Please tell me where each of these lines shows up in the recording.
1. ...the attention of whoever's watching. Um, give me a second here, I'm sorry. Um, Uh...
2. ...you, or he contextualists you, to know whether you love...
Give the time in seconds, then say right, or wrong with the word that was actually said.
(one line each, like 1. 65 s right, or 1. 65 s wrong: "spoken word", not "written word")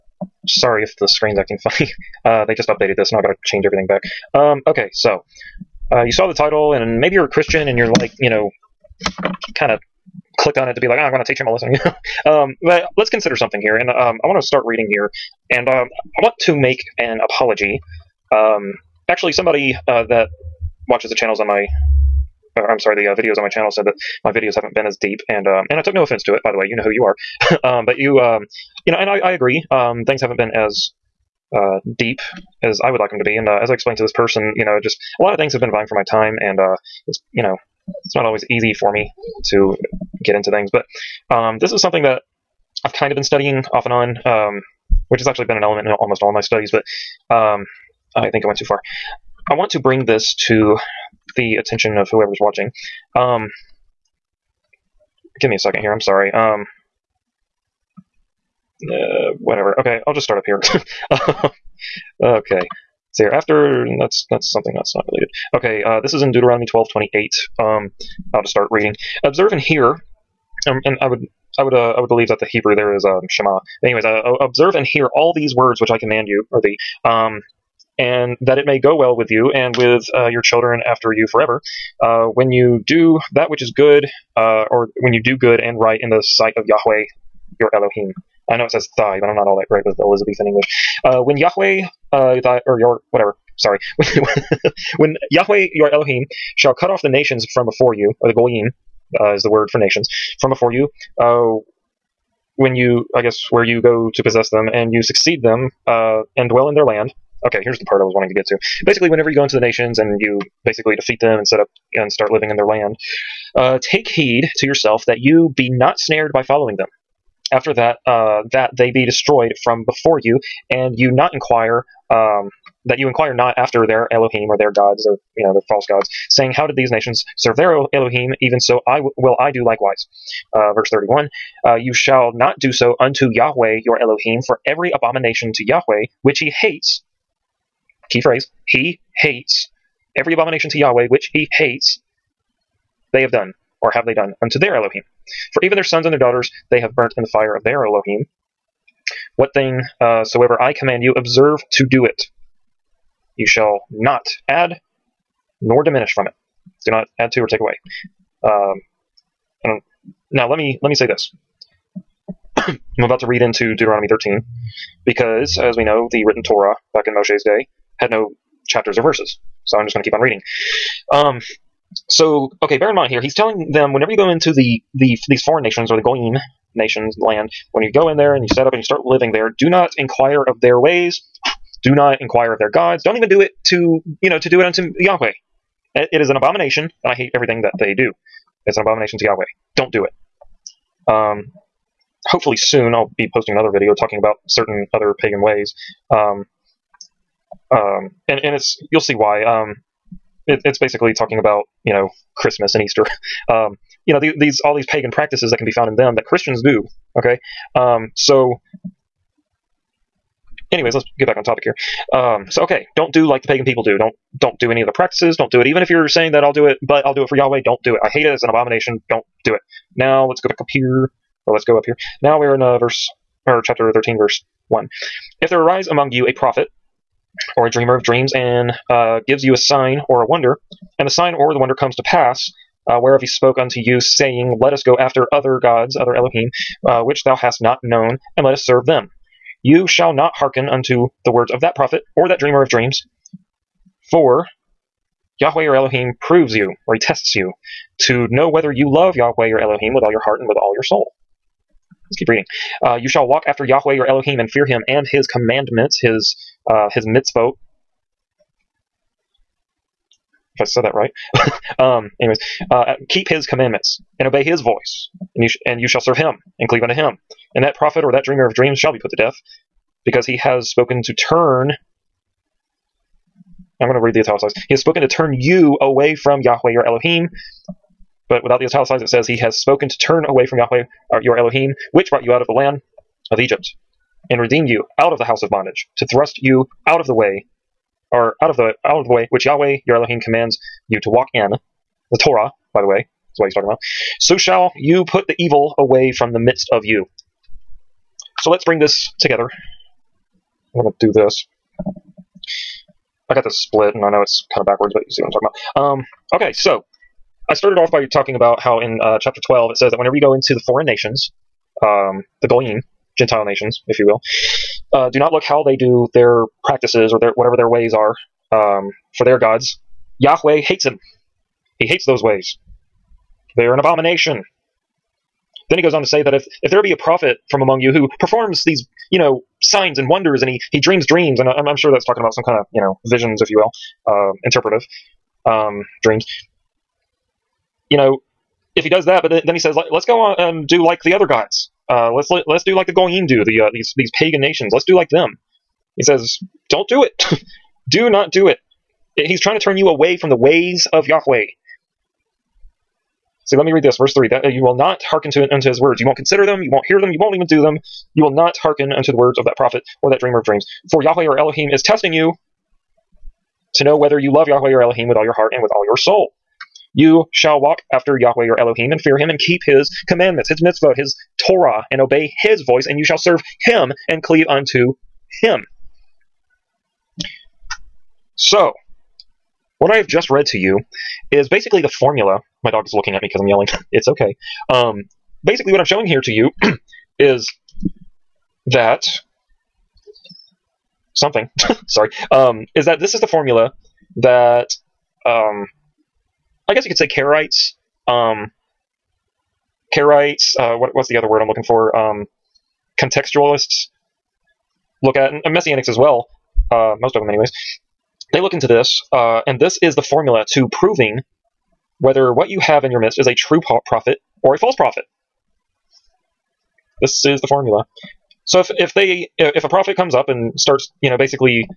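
1. 51 s right
2. 246 s wrong: "tests", not "contextualists".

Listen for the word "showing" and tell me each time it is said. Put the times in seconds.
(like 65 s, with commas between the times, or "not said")
385 s.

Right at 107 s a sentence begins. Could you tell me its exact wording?
Okay, here's the part I was wanting to get to.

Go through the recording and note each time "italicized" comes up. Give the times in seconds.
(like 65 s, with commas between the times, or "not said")
274 s, 278 s.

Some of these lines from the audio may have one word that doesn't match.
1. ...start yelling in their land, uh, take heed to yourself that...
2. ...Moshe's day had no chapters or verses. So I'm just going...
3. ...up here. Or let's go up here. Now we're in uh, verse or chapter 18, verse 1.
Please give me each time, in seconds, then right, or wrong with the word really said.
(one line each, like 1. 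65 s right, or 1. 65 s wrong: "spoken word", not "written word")
1. 112 s wrong: "living", not "yelling"
2. 167 s right
3. 220 s wrong: "13", not "18".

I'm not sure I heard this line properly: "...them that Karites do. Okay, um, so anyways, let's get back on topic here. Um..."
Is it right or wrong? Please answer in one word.
wrong.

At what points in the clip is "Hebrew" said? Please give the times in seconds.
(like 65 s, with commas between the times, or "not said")
72 s.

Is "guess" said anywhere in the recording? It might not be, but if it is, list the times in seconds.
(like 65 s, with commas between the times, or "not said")
103 s, 396 s.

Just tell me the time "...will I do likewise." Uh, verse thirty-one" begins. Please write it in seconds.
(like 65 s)
129 s.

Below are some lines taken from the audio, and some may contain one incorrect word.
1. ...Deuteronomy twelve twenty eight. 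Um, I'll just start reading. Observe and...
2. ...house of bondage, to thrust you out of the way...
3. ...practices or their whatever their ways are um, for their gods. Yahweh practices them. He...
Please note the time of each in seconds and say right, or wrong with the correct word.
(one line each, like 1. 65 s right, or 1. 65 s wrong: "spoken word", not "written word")
1. 66 s right
2. 285 s right
3. 316 s wrong: "hates", not "practices".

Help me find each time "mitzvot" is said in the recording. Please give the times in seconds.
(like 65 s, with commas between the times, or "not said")
257 s, 370 s.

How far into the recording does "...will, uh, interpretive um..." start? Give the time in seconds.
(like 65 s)
333 s.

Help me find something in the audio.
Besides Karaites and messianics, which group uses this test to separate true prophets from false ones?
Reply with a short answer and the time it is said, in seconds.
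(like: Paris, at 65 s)
contextualists, at 402 s.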